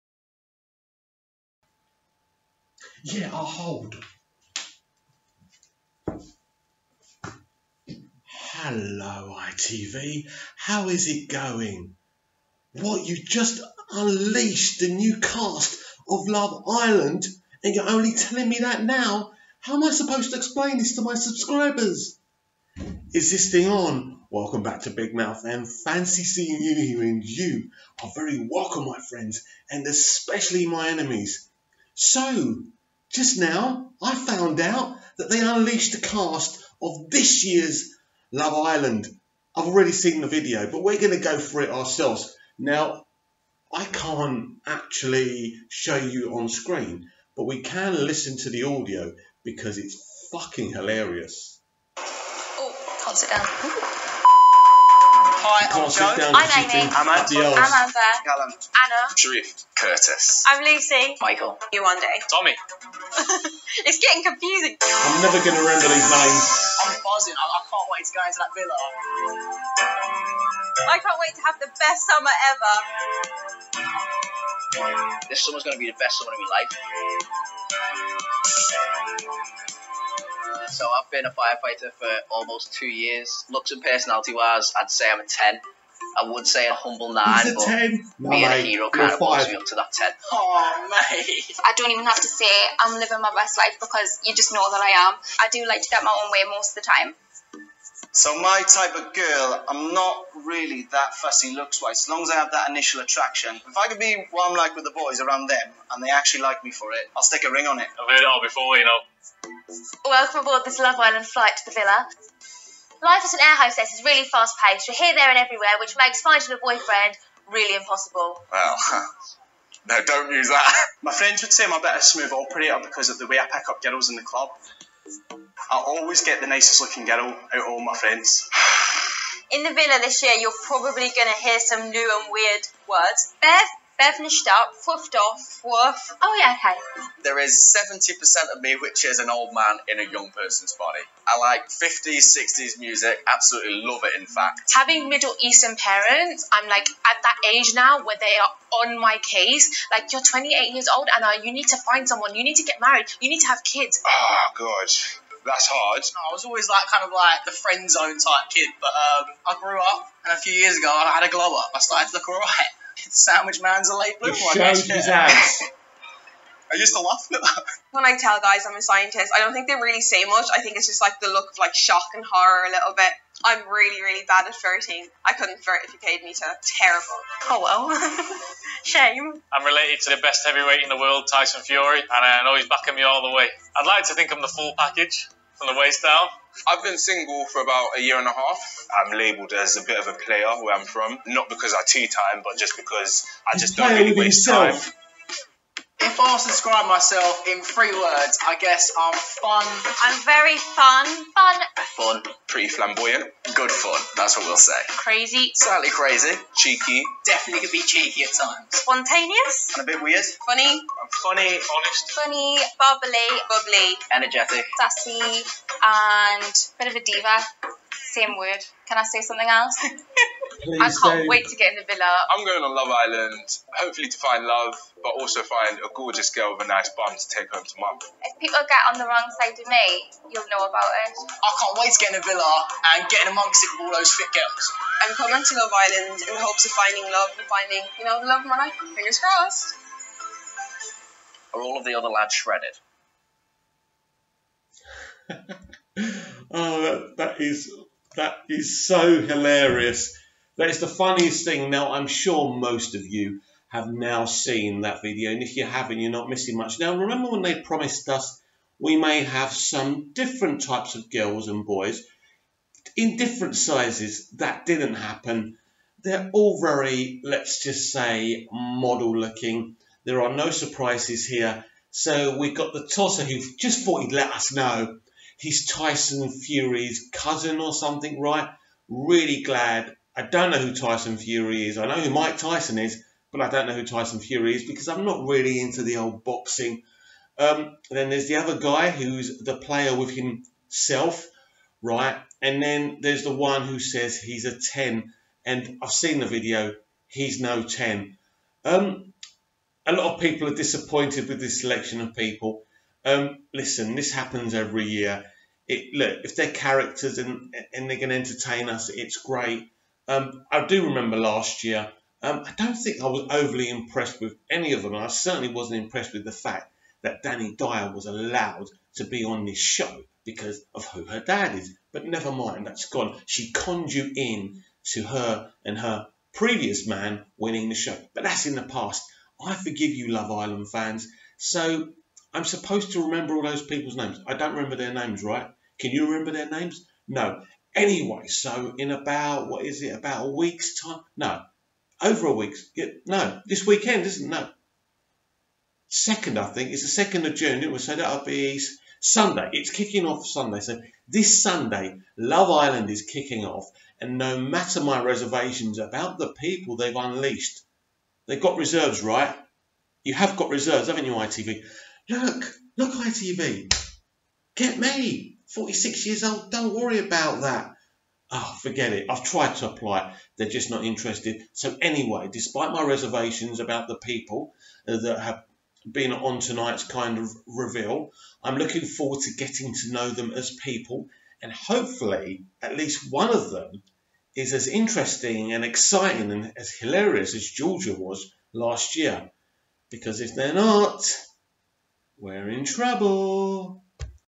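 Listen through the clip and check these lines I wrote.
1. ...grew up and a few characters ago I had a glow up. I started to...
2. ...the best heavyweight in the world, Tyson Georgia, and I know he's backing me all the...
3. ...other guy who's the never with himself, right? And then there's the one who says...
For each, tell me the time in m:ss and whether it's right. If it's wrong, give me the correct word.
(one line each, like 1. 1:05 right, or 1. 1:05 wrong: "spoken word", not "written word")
1. 2:39 wrong: "years", not "characters"
2. 3:00 wrong: "Fury", not "Georgia"
3. 4:48 wrong: "player", not "never".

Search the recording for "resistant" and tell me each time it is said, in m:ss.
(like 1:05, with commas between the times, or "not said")
not said.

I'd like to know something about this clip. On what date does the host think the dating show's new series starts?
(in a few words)
2 June.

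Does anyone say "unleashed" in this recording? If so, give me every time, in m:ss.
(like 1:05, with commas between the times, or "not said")
0:13, 0:35, 5:56.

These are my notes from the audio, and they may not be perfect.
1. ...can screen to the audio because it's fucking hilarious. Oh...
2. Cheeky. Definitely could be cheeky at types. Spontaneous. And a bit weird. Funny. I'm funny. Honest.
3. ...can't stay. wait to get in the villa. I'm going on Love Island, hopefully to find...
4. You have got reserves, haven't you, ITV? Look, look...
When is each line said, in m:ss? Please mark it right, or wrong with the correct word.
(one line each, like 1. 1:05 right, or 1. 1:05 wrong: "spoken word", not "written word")
1. 0:47 wrong: "listen", not "screen"
2. 3:26 wrong: "times", not "types"
3. 3:40 right
4. 6:00 right.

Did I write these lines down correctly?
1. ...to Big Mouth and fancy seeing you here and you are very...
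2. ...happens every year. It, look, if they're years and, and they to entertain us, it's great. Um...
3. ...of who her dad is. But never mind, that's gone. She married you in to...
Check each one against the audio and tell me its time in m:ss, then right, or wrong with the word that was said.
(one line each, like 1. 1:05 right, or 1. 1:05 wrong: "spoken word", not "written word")
1. 0:24 right
2. 5:04 wrong: "characters", not "years"
3. 5:20 wrong: "conned", not "married".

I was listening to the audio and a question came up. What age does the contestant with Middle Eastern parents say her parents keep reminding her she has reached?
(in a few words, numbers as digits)
28.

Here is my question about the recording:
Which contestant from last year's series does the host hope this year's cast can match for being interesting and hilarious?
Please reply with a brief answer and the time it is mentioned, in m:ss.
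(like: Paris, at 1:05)
Georgia, at 6:27.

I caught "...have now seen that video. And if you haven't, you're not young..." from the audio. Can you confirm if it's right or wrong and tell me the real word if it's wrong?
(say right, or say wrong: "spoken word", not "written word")
wrong: "missing", not "young".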